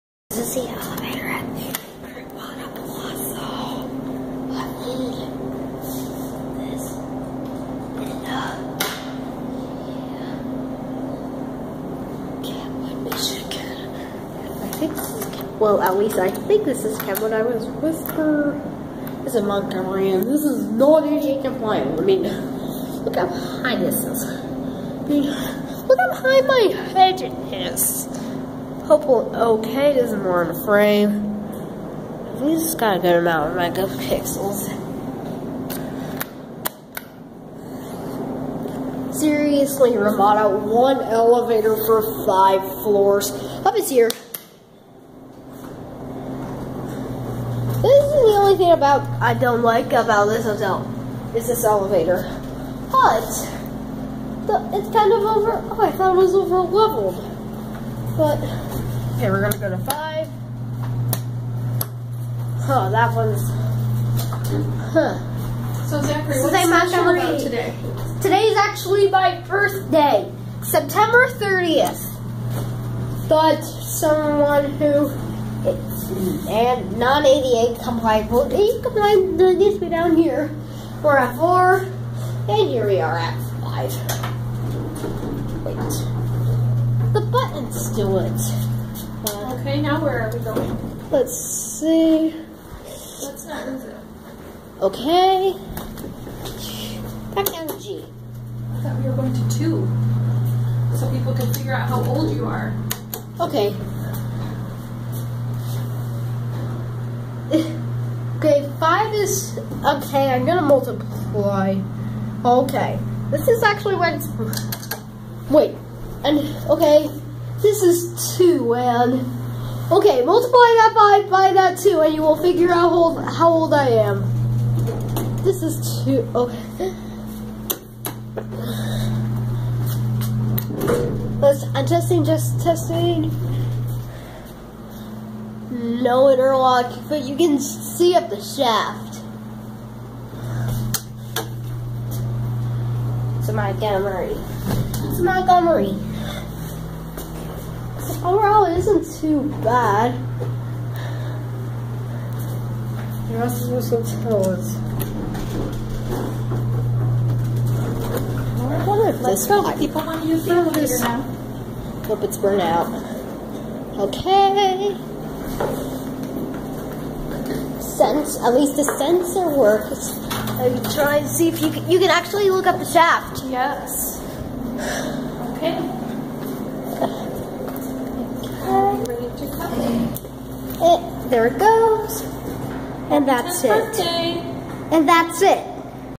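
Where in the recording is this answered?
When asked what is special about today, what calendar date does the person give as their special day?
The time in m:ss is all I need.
1:10.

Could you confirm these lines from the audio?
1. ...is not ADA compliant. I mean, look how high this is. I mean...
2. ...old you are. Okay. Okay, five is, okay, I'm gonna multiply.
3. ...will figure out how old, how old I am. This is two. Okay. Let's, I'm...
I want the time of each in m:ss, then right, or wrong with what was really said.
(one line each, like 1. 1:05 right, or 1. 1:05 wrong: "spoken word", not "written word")
1. 0:20 right
2. 1:42 right
3. 2:02 right.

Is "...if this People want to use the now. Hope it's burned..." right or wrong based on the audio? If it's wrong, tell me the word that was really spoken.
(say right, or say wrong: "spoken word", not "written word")
right.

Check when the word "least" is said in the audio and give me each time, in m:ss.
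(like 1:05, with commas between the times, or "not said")
0:15, 2:48.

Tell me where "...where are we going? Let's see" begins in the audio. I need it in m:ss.
1:30.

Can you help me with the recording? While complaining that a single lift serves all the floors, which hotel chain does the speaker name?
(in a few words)
Ramada.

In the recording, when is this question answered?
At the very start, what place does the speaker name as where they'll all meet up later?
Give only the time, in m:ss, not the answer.
0:01.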